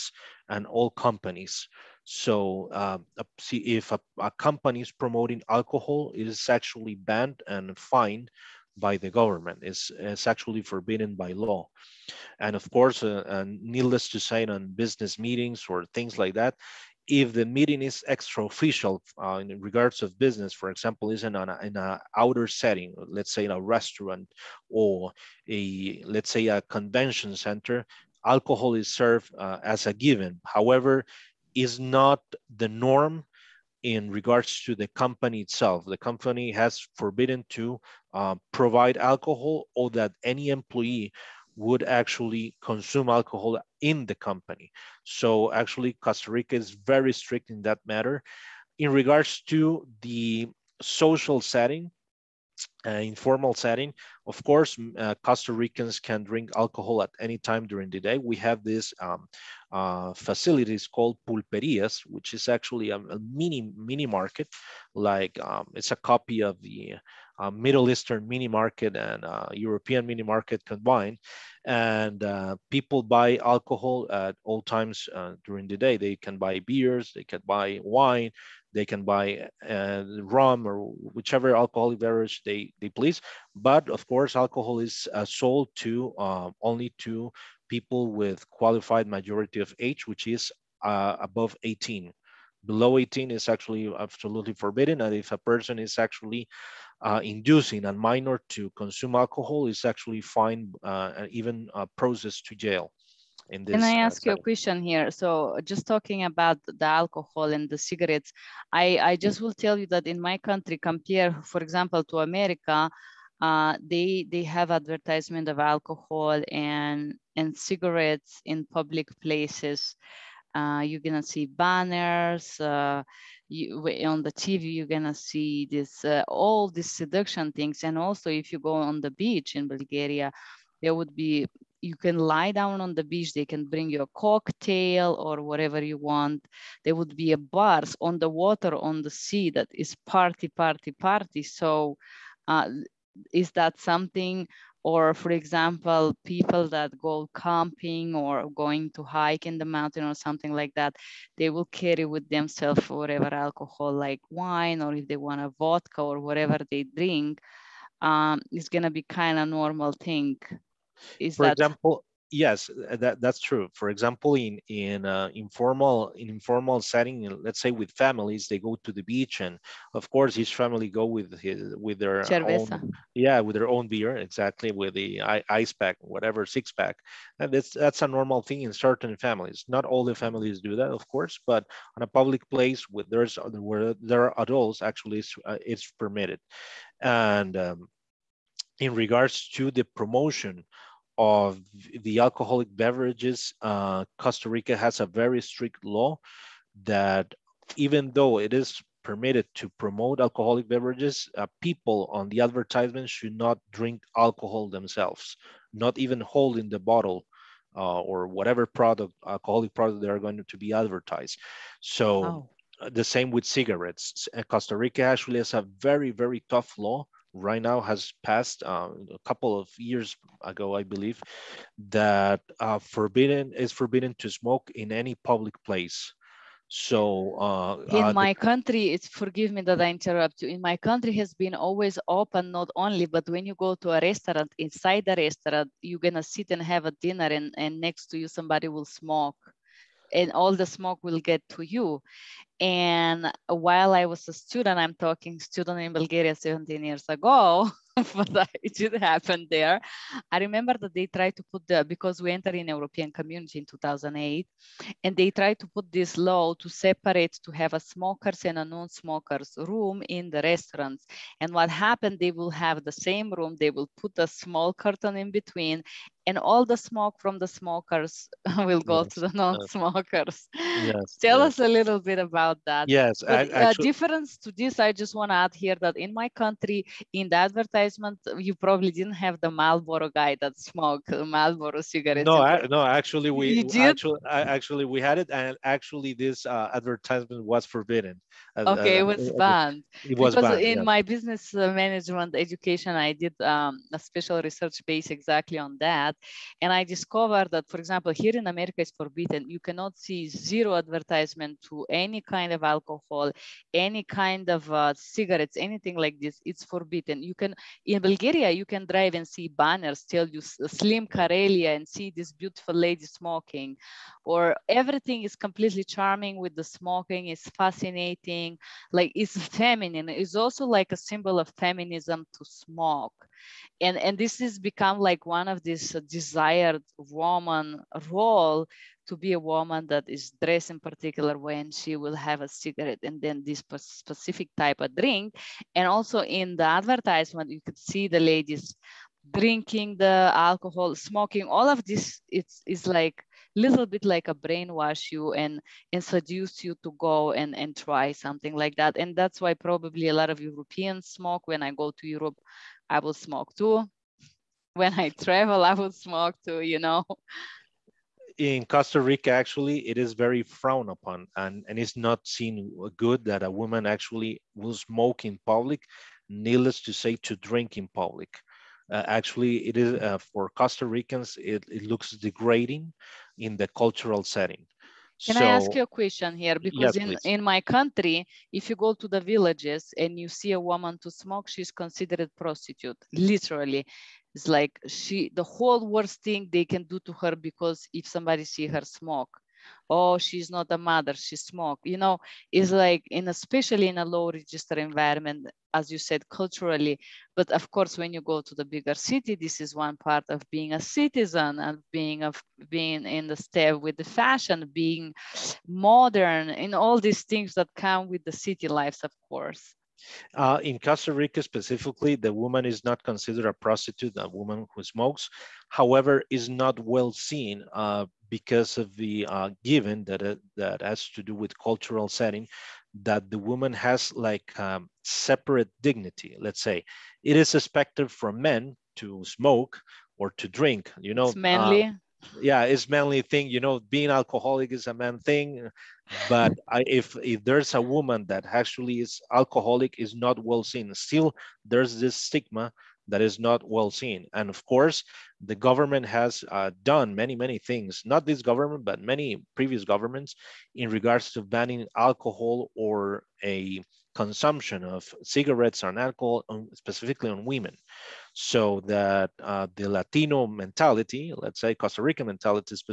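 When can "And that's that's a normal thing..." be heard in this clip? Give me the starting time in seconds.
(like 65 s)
177 s.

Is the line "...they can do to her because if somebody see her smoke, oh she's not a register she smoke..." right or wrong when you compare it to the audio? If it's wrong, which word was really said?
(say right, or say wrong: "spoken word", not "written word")
wrong: "mother", not "register".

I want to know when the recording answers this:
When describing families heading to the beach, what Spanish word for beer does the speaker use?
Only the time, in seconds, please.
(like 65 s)
172 s.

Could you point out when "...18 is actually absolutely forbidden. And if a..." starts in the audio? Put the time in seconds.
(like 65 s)
92 s.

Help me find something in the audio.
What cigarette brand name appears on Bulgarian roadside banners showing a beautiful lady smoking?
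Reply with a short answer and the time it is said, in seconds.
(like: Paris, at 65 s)
Slim Karelia, at 310 s.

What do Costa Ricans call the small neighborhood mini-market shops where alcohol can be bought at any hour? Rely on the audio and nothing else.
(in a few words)
pulperias.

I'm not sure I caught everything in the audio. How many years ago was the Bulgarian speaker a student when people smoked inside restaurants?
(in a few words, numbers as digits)
17 years.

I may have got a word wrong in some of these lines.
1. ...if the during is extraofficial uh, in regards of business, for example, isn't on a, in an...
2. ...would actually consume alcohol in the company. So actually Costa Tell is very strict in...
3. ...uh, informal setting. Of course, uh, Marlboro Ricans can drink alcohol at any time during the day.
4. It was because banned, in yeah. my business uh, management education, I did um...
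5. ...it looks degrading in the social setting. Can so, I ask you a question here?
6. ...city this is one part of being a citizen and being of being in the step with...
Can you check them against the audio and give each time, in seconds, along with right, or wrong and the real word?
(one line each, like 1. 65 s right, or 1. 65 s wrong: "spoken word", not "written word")
1. 17 s wrong: "meeting", not "during"
2. 41 s wrong: "Rica", not "Tell"
3. 52 s wrong: "Costa", not "Marlboro"
4. 290 s right
5. 371 s wrong: "cultural", not "social"
6. 398 s right.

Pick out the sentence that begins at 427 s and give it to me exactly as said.
It is expected from men to smoke or to drink, you know.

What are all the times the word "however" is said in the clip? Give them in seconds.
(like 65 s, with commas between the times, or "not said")
30 s, 415 s.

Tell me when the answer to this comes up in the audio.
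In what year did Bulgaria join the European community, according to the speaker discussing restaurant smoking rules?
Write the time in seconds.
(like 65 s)
253 s.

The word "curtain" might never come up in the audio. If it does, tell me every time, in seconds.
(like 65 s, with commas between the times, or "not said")
264 s.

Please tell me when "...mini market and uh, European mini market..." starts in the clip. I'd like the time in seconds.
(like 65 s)
68 s.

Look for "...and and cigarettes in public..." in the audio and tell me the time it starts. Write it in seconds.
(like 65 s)
116 s.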